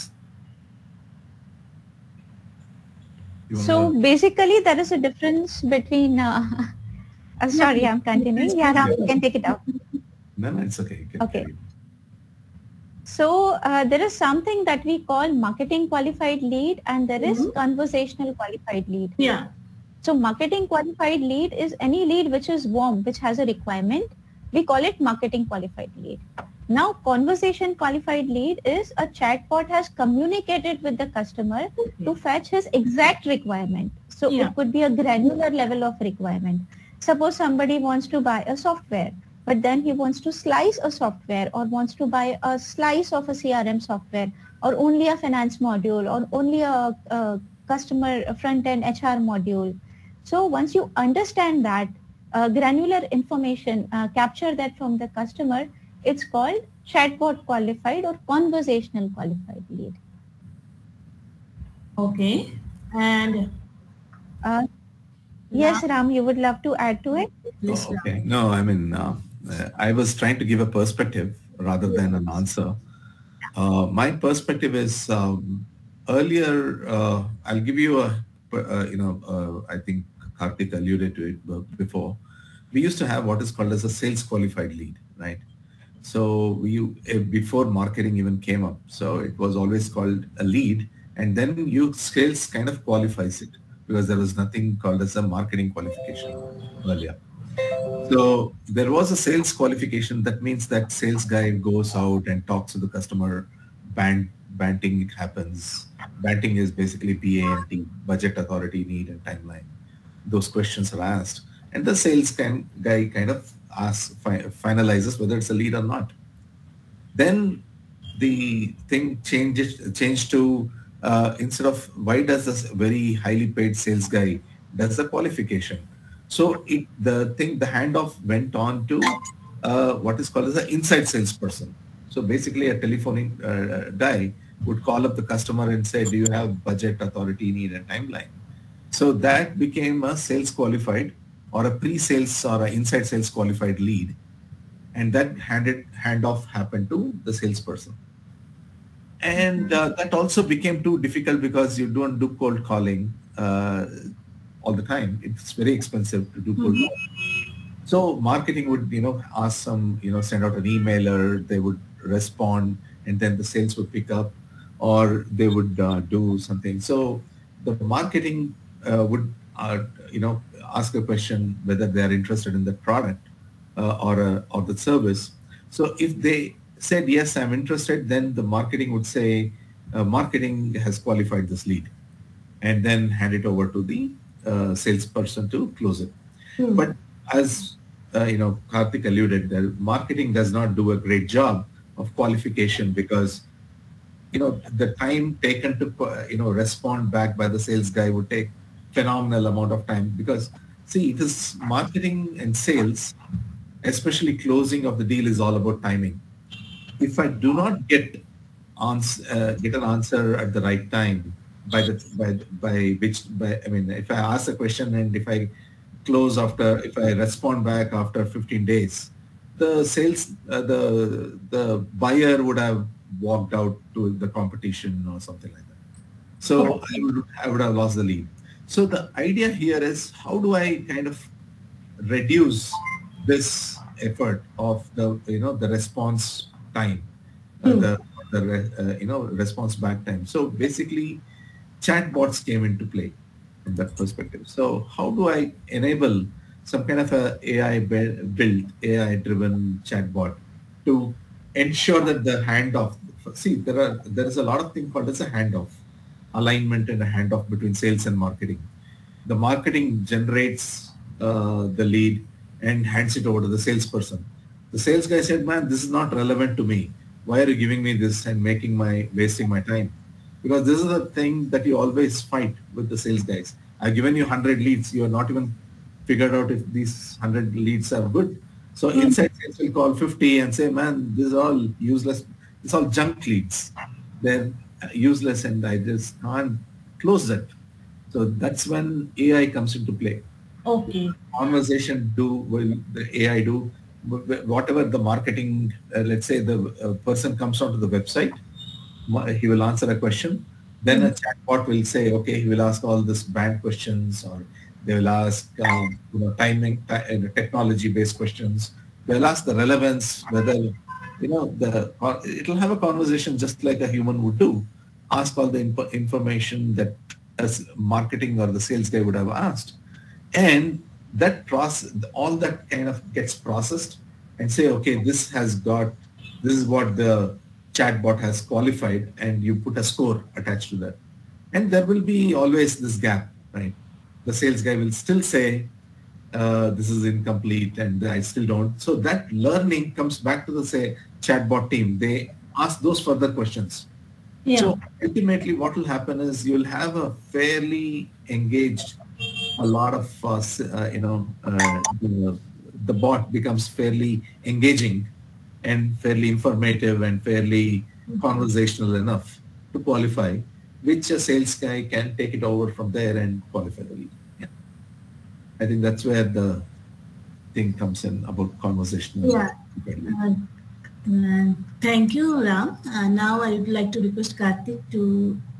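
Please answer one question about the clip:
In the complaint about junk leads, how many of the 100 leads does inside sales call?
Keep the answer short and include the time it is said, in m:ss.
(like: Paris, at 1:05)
50, at 4:39.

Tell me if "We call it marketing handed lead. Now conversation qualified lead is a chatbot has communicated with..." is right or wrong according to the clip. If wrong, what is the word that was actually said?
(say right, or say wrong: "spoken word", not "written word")
wrong: "qualified", not "handed".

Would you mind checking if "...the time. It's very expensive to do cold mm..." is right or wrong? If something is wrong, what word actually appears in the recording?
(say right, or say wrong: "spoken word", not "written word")
right.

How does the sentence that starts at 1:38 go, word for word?
So there was a sales qualification.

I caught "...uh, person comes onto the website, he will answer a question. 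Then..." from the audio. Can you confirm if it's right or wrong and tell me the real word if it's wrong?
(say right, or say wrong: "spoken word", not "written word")
right.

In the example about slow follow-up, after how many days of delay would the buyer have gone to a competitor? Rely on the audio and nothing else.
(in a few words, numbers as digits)
15.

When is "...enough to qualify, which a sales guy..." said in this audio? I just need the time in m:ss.
5:58.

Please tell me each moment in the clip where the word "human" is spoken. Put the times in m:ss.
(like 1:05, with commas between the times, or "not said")
5:13.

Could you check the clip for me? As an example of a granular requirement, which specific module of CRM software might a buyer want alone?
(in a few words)
finance module.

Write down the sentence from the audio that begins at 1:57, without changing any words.
Then the thing changes changed to uh, instead of why does this very highly paid sales guy does the qualification.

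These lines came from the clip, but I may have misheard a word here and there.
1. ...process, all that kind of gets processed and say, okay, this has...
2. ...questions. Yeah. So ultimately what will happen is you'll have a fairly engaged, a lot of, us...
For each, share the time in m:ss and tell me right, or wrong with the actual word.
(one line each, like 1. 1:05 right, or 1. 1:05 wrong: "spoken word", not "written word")
1. 5:21 right
2. 5:43 right.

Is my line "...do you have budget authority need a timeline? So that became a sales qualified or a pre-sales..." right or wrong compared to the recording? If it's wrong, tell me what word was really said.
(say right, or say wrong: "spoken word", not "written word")
right.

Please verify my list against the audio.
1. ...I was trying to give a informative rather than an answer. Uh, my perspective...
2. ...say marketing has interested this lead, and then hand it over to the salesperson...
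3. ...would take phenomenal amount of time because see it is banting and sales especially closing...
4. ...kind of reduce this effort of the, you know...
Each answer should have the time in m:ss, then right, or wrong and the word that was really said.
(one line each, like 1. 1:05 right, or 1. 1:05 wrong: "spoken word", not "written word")
1. 1:09 wrong: "perspective", not "informative"
2. 2:59 wrong: "qualified", not "interested"
3. 3:18 wrong: "marketing", not "banting"
4. 3:50 right.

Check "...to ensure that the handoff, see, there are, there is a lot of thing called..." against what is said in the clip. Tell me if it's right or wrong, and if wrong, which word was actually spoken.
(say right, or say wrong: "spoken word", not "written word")
right.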